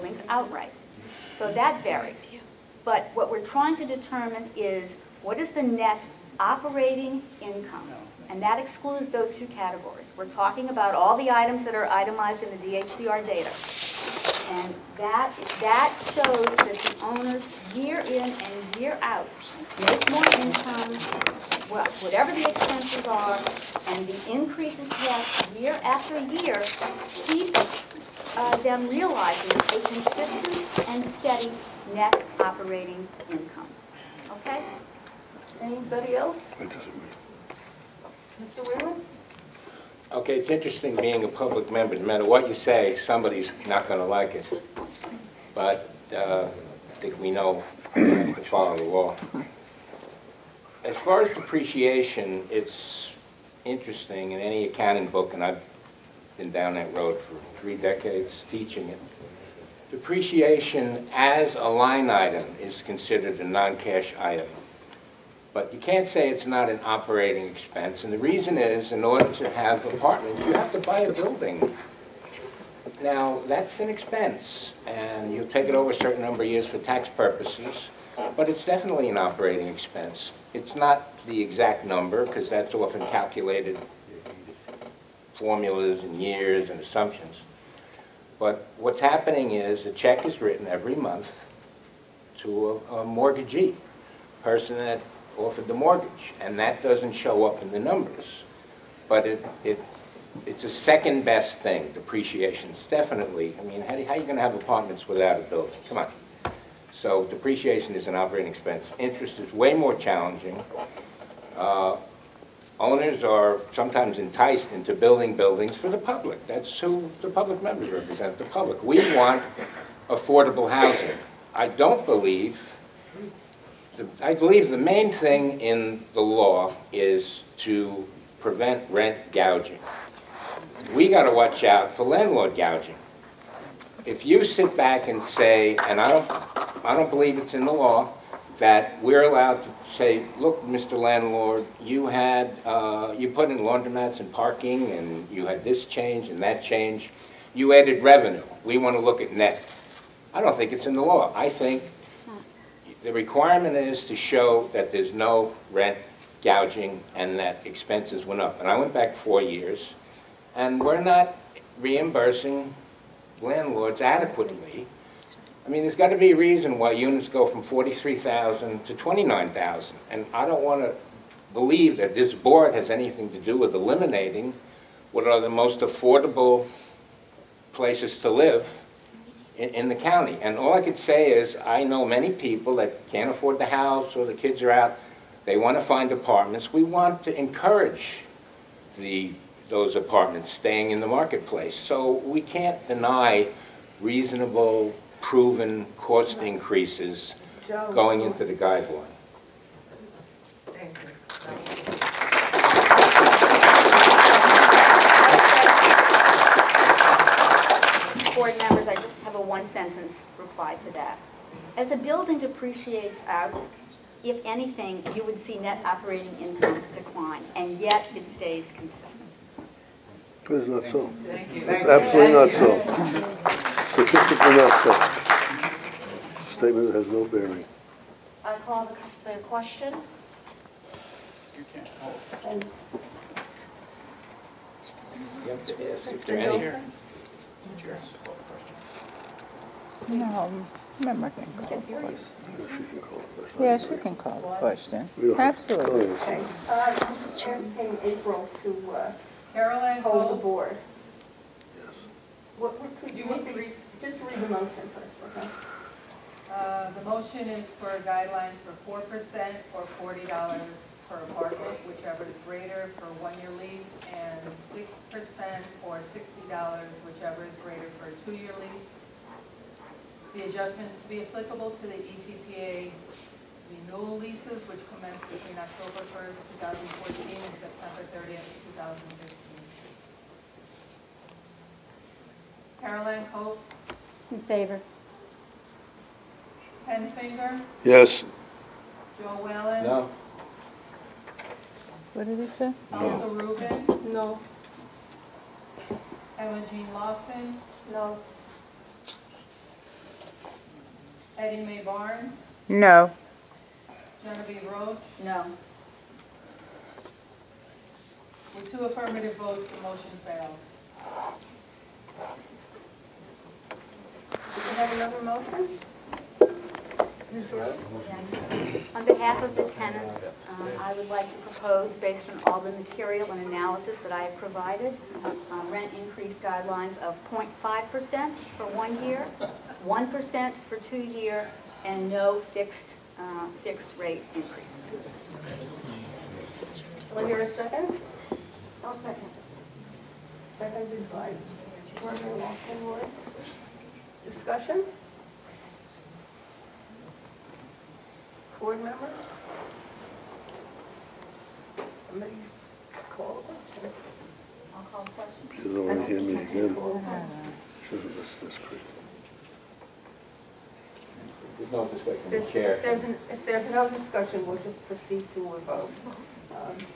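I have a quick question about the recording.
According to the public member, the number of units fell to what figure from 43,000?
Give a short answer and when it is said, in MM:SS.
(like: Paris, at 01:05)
29,000, at 02:48.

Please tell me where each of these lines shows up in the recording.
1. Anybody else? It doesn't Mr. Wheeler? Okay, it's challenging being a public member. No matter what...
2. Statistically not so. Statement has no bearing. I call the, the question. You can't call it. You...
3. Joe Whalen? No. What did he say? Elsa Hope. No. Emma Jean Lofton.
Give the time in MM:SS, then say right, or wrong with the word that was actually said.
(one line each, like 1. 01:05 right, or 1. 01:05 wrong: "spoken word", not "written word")
1. 00:35 wrong: "interesting", not "challenging"
2. 03:43 right
3. 04:49 wrong: "Rubin", not "Hope".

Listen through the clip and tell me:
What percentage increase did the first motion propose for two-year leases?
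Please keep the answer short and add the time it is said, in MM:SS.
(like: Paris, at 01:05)
6%, at 04:24.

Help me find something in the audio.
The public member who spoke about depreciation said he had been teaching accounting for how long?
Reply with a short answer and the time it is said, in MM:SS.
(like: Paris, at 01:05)
3 decades, at 00:57.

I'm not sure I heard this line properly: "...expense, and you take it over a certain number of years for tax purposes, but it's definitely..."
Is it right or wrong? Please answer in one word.
right.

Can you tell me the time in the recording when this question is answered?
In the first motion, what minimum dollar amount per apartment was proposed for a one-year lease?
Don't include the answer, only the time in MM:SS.
04:19.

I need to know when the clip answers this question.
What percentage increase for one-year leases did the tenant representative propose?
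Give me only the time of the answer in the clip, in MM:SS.
05:27.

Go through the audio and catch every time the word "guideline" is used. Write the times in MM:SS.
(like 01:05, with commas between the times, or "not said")
03:18, 04:18, 05:26.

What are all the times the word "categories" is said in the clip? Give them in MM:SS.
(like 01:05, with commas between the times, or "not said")
00:09.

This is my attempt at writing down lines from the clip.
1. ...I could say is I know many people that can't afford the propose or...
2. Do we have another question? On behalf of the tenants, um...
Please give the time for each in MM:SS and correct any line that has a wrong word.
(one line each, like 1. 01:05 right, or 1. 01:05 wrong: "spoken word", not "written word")
1. 03:00 wrong: "house", not "propose"
2. 05:14 wrong: "motion", not "question".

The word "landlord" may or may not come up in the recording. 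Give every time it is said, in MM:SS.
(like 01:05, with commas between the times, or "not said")
02:12, 02:20, 02:43.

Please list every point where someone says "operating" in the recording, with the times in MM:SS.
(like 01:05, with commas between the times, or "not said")
00:06, 00:32, 01:06, 01:19, 01:48, 03:35.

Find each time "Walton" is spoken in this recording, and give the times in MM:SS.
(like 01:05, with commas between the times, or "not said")
05:42.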